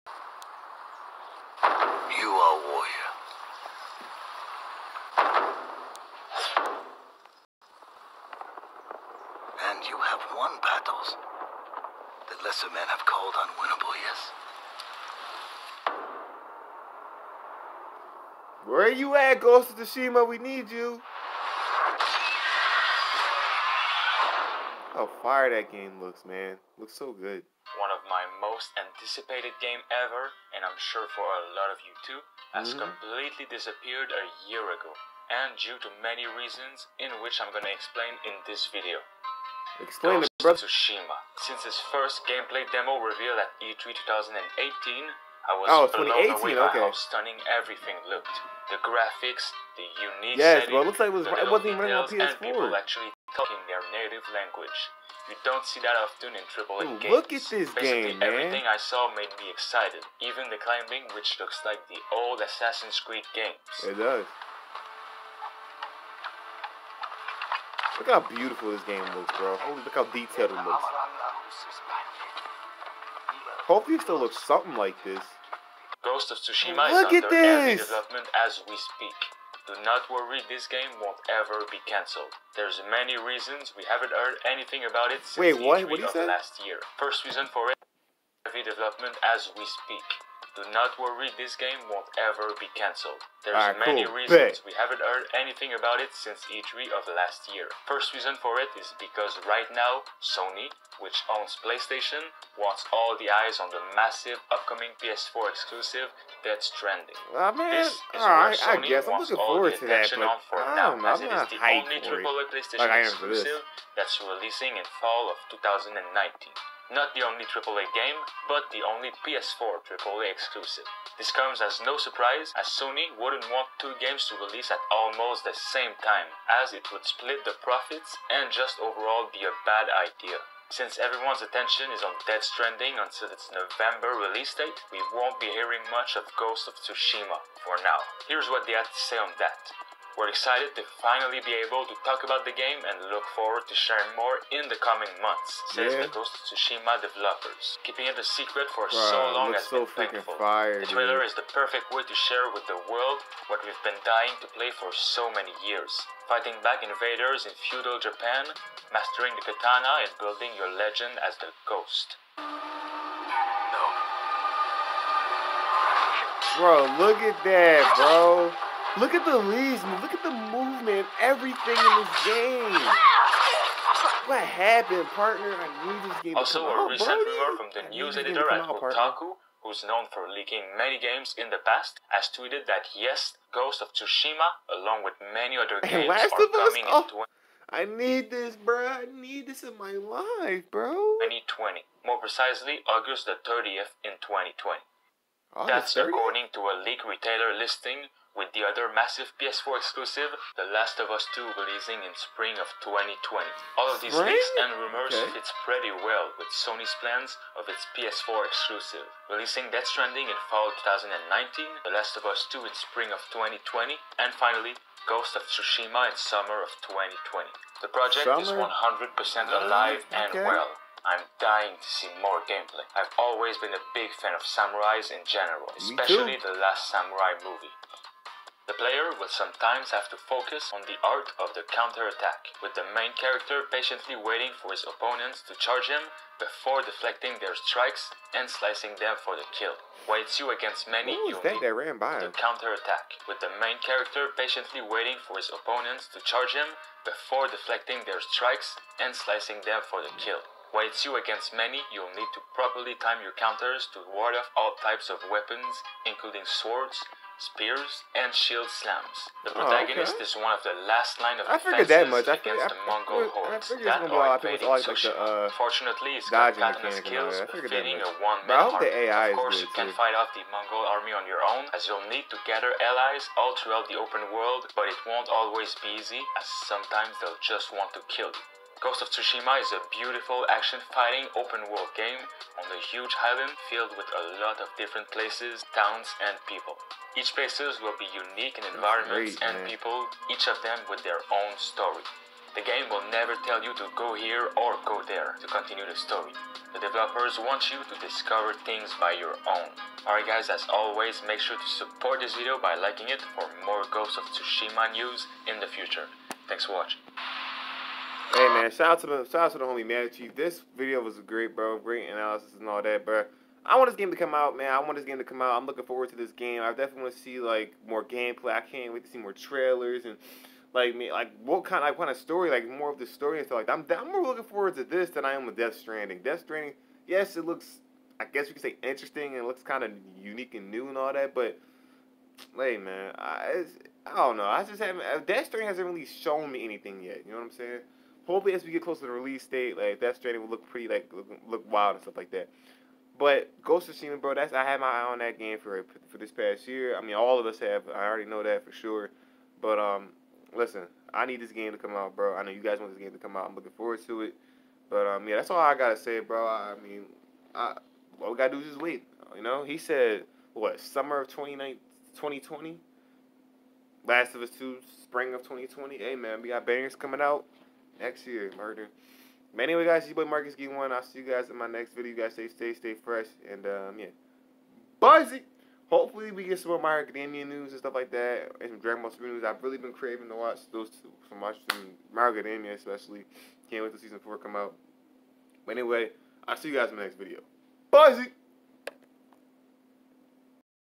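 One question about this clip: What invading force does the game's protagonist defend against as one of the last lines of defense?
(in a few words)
Mongol hordes.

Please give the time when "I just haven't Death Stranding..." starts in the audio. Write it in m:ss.
5:34.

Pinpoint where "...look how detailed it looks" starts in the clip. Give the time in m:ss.
1:09.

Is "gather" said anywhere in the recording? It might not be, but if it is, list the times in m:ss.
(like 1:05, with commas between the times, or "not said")
4:32.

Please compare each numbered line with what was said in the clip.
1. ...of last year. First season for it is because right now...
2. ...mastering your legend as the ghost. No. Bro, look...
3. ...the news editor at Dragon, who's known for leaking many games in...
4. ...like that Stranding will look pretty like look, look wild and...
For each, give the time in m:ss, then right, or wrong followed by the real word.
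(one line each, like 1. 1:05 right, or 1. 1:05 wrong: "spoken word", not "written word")
1. 1:36 wrong: "reason", not "season"
2. 2:40 wrong: "building", not "mastering"
3. 2:57 wrong: "Kotaku", not "Dragon"
4. 5:39 right.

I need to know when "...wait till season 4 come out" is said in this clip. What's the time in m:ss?
6:23.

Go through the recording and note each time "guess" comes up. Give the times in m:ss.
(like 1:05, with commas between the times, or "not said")
1:48, 5:28.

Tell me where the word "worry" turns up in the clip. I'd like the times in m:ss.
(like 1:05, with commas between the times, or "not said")
1:20, 1:30.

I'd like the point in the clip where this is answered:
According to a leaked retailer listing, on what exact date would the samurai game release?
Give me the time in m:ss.
3:12.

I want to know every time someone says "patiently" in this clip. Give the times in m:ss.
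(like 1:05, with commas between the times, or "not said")
3:53, 4:04.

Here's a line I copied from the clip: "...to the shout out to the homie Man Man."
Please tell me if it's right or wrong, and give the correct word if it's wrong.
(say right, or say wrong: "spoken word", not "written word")
wrong: "Chief", not "Man".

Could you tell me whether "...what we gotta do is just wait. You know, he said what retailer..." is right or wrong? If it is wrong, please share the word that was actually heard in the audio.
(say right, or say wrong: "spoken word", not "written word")
wrong: "summer", not "retailer".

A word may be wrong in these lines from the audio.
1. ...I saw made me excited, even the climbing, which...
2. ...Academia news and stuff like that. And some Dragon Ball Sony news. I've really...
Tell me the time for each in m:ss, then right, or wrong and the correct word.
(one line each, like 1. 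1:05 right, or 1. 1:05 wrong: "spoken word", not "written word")
1. 0:58 right
2. 6:17 wrong: "Super", not "Sony".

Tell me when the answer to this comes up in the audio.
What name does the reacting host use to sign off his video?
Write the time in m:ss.
6:10.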